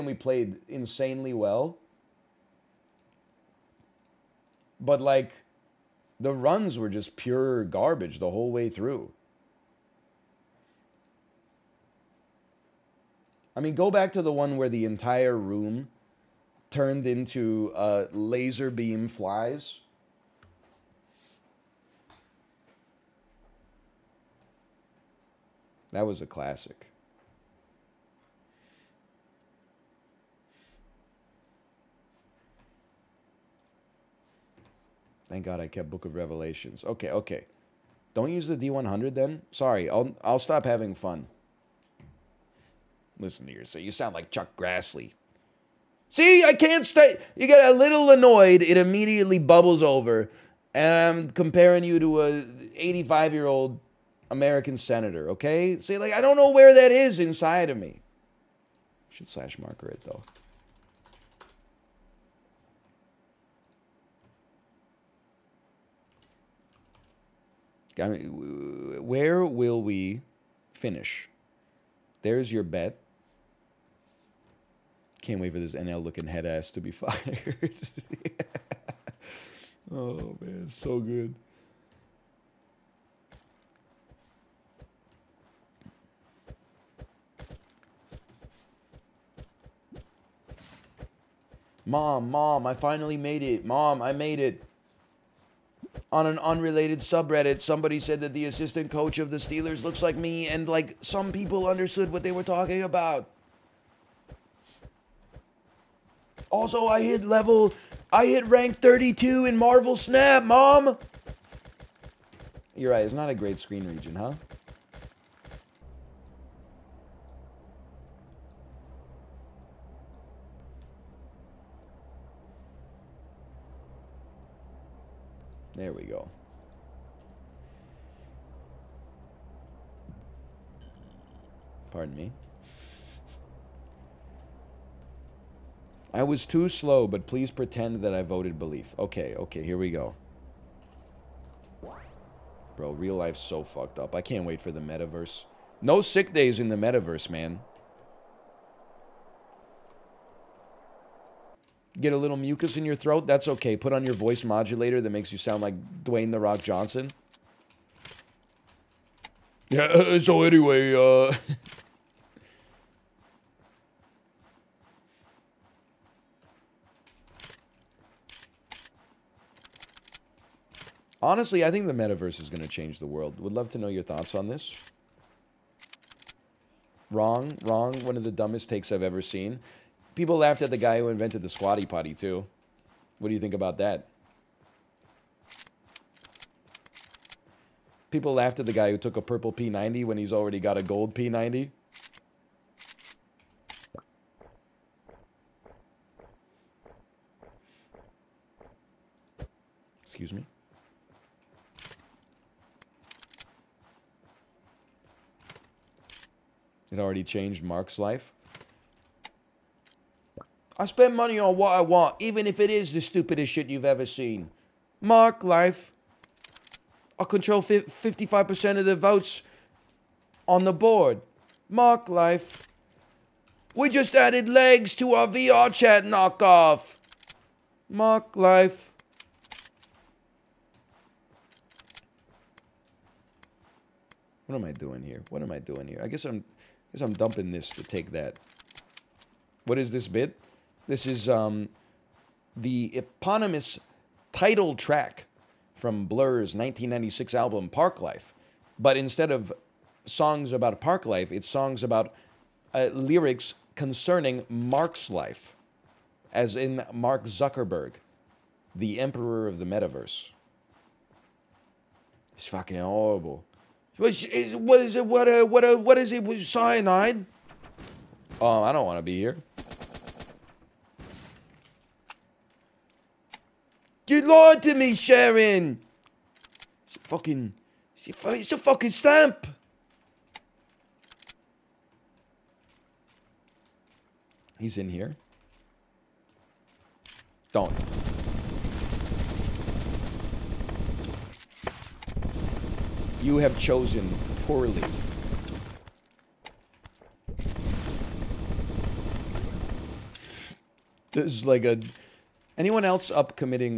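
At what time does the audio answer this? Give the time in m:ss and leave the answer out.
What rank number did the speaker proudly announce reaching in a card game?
1:48.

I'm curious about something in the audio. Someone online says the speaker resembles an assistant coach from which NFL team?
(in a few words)
Steelers.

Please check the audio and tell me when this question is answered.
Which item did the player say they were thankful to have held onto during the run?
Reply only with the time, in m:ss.
0:35.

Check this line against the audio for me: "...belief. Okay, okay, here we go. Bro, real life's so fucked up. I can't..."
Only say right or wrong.
right.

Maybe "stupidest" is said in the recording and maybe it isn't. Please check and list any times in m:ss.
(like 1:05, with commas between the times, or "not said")
3:33.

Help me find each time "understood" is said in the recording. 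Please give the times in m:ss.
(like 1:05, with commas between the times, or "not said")
1:41.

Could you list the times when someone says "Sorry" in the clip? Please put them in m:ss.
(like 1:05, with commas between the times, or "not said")
0:39.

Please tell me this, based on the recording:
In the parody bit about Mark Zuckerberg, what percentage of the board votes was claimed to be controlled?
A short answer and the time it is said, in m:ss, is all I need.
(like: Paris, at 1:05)
55%, at 3:37.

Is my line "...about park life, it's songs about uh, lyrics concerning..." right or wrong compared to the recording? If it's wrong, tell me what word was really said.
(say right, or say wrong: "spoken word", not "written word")
right.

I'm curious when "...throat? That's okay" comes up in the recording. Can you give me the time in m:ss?
2:32.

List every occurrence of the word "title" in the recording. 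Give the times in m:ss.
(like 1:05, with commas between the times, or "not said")
4:04.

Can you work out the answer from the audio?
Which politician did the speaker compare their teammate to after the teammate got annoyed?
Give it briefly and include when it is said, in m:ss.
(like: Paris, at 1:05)
Chuck Grassley, at 0:44.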